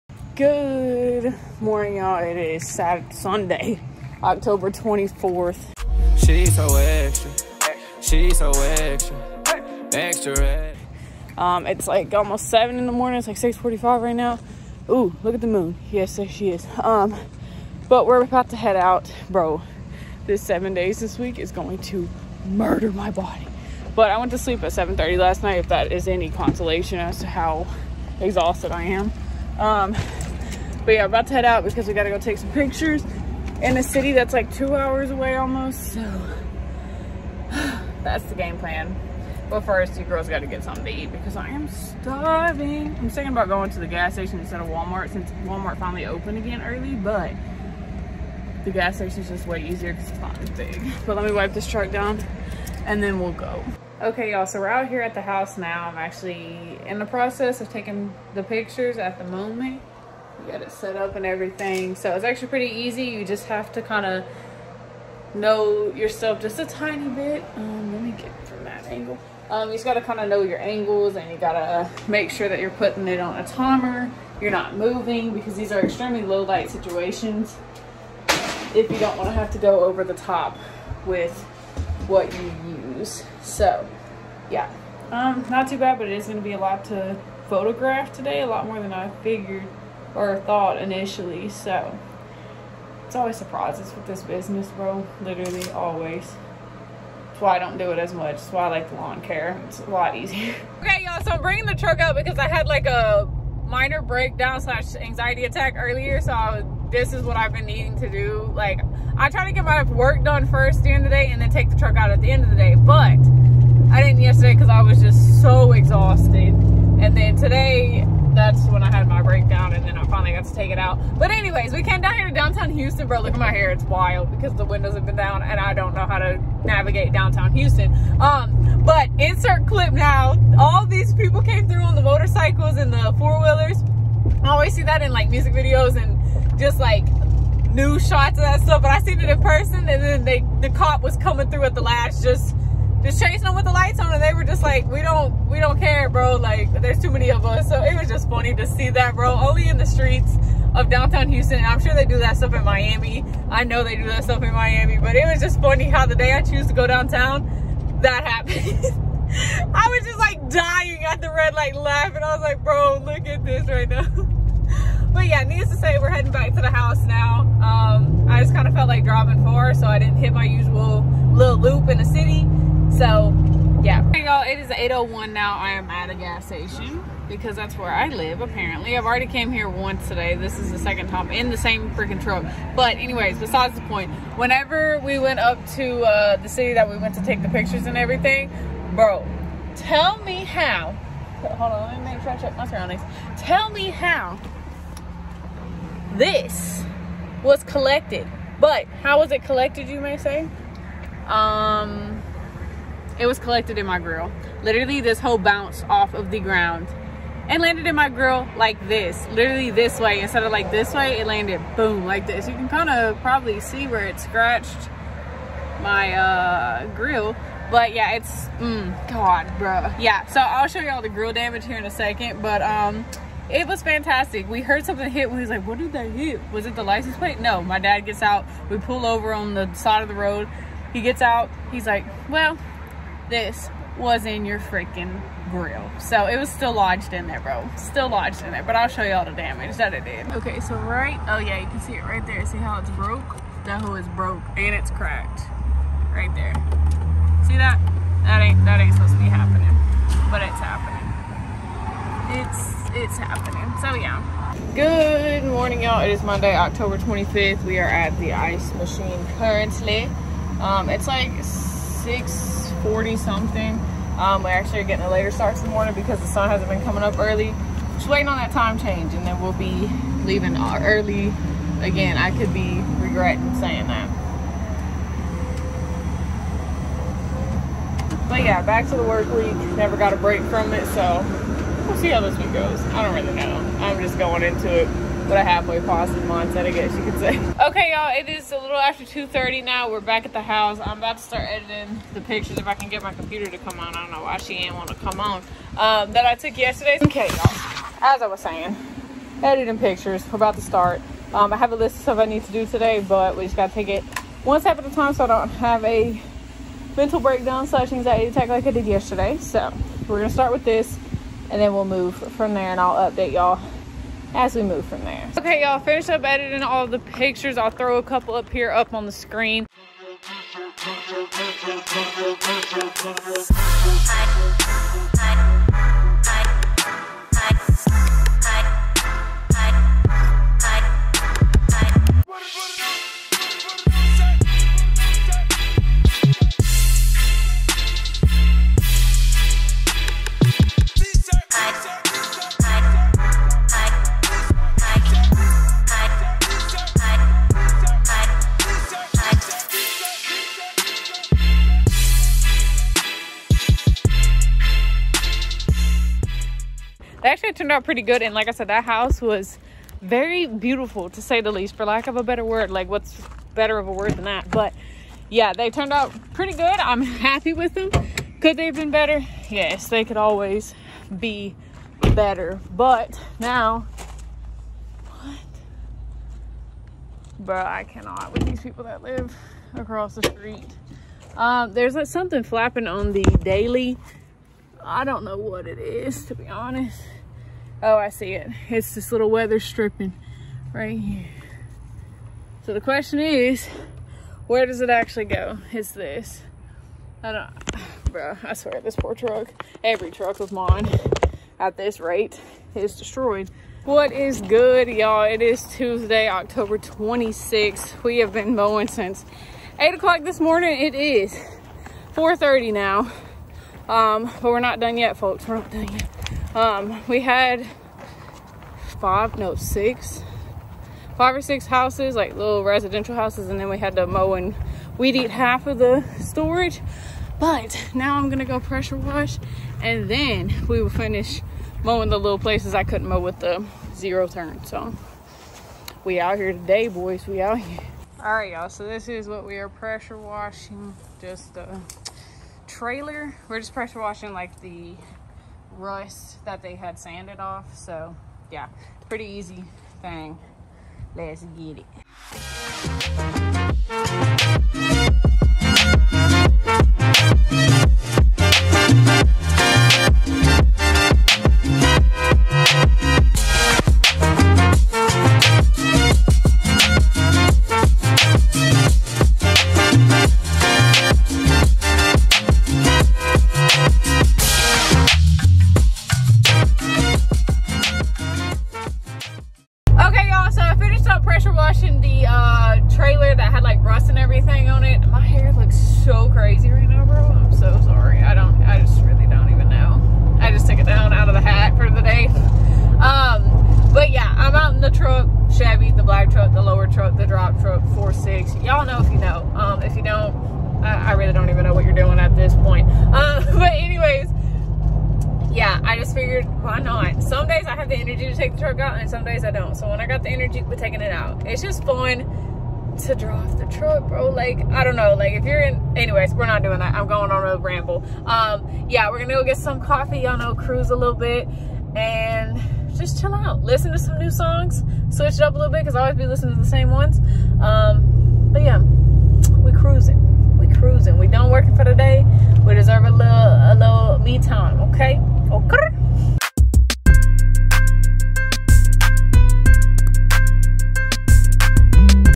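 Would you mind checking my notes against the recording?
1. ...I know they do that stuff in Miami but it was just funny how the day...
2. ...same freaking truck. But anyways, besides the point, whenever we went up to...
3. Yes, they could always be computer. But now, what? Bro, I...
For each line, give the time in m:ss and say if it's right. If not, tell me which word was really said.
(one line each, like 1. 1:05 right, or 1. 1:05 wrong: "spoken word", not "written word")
1. 2:33 right
2. 3:01 right
3. 6:09 wrong: "better", not "computer".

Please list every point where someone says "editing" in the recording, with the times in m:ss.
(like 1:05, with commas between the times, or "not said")
4:51, 4:59, 5:16.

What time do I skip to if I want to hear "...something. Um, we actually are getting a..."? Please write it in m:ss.
4:23.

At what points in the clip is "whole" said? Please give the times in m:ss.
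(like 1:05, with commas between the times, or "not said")
3:25.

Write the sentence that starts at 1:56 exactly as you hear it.
And then today, that's when I got to take it out.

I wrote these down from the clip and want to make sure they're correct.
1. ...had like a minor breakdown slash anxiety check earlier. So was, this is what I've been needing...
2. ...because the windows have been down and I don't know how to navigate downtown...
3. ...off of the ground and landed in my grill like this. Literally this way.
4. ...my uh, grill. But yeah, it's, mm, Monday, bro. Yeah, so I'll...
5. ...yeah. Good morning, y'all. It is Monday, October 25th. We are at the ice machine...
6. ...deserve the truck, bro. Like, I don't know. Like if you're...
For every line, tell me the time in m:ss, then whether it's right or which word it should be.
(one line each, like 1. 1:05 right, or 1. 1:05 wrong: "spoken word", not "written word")
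1. 1:42 wrong: "attack", not "check"
2. 2:04 right
3. 3:25 right
4. 3:35 wrong: "God", not "Monday"
5. 4:13 right
6. 8:33 wrong: "drive", not "deserve".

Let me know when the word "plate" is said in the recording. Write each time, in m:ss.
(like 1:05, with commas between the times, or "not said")
3:47.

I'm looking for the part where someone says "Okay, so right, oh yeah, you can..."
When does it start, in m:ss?
4:00.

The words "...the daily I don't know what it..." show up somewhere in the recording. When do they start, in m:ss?
6:23.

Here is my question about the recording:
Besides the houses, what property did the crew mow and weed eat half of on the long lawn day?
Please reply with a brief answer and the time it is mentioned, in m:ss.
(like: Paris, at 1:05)
The storage, at 7:06.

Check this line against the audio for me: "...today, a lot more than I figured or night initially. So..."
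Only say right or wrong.
wrong.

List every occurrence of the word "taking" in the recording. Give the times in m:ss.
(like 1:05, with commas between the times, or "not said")
0:57, 8:30.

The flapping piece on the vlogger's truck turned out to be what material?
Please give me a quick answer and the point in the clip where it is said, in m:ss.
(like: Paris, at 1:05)
Weather stripping, at 6:29.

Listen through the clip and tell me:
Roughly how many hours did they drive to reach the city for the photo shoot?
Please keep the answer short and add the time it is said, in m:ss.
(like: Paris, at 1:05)
2 hours, at 0:34.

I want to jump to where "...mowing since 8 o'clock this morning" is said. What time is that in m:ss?
6:48.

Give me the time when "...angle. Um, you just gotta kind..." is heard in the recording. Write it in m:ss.
1:08.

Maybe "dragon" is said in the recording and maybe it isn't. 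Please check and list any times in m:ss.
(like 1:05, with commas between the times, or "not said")
not said.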